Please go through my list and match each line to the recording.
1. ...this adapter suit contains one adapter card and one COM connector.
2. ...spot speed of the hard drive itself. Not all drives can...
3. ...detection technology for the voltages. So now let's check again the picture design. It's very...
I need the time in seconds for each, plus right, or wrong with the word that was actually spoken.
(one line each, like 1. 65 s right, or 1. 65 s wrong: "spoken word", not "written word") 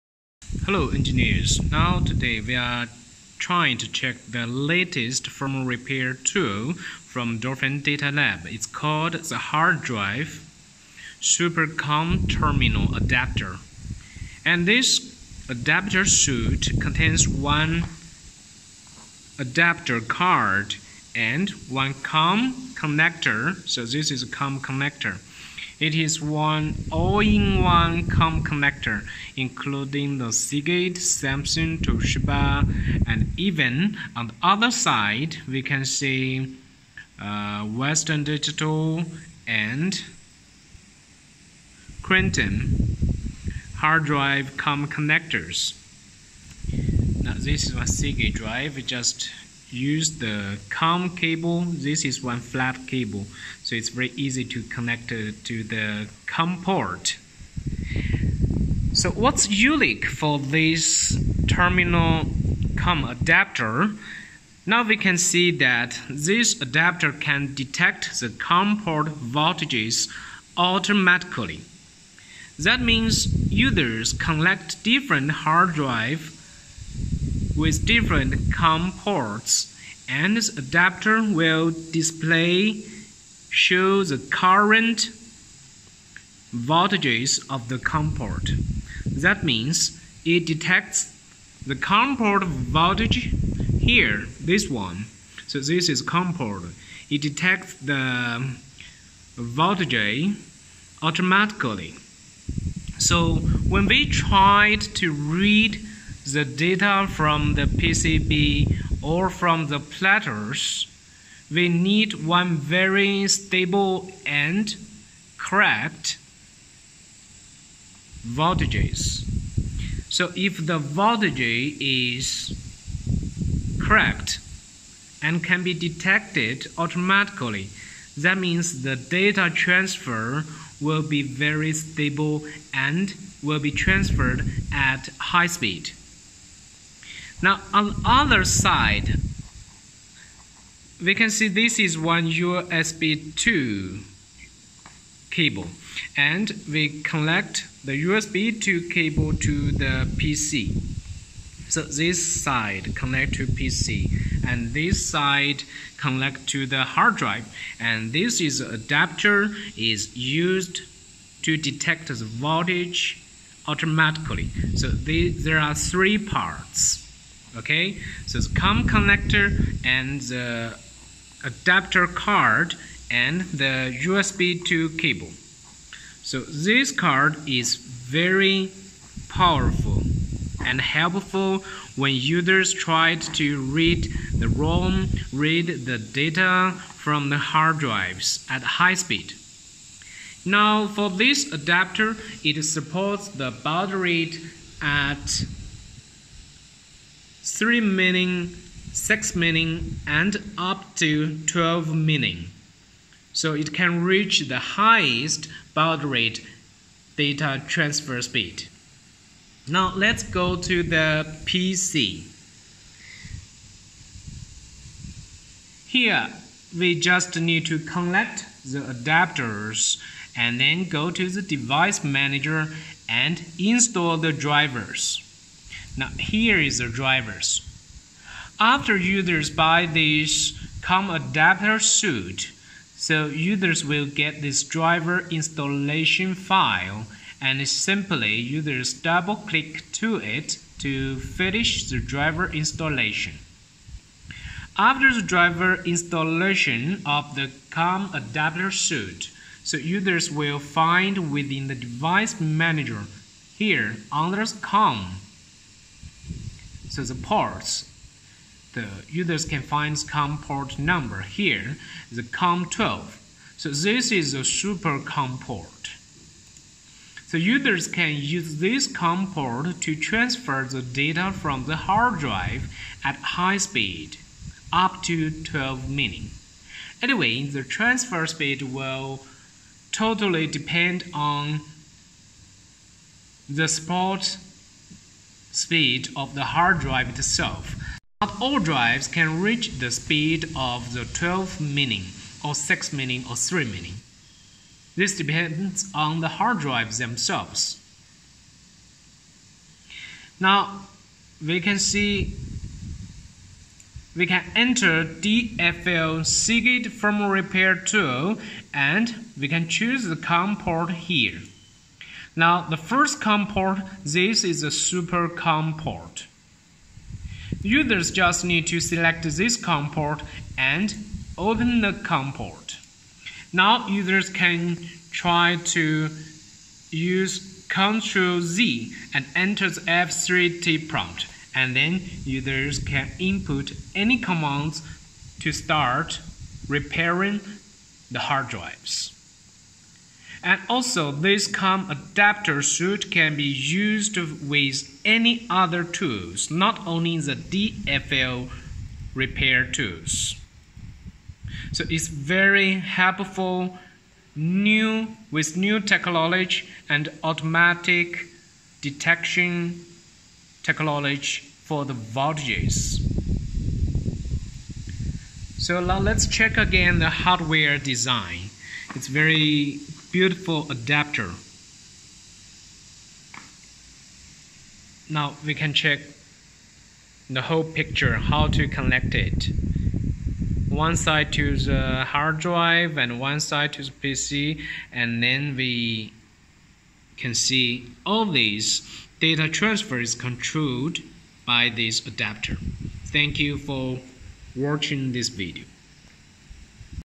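1. 14 s right
2. 283 s right
3. 358 s wrong: "hardware", not "picture".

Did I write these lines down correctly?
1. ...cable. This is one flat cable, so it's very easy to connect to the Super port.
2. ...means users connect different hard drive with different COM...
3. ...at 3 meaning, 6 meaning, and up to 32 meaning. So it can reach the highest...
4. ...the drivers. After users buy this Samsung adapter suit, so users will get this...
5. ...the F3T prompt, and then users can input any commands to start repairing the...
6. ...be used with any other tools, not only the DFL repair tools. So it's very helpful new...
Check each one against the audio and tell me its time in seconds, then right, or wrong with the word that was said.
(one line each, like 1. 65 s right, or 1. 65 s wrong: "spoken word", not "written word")
1. 51 s wrong: "COM", not "Super"
2. 72 s right
3. 194 s wrong: "12", not "32"
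4. 226 s wrong: "COM", not "Samsung"
5. 329 s right
6. 343 s right.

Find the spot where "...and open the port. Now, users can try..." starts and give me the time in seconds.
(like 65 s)
320 s.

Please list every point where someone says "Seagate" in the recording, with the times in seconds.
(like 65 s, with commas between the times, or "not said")
30 s, 47 s, 306 s.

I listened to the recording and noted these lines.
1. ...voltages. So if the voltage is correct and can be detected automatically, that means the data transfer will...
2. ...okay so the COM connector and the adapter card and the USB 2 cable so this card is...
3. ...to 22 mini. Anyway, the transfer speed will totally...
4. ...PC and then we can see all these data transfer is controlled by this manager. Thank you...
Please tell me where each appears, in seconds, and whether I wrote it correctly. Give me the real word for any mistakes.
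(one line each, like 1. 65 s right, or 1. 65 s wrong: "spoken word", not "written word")
1. 118 s right
2. 167 s right
3. 275 s wrong: "12", not "22"
4. 383 s wrong: "adapter", not "manager".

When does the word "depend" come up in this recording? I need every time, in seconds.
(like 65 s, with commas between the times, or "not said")
280 s, 295 s.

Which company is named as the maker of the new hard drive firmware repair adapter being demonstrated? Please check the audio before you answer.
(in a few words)
Dolphin Data Lab.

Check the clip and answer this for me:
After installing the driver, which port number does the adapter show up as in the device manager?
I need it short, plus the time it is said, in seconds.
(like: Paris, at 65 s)
COM12, at 262 s.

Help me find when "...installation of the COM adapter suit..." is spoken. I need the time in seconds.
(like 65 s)
245 s.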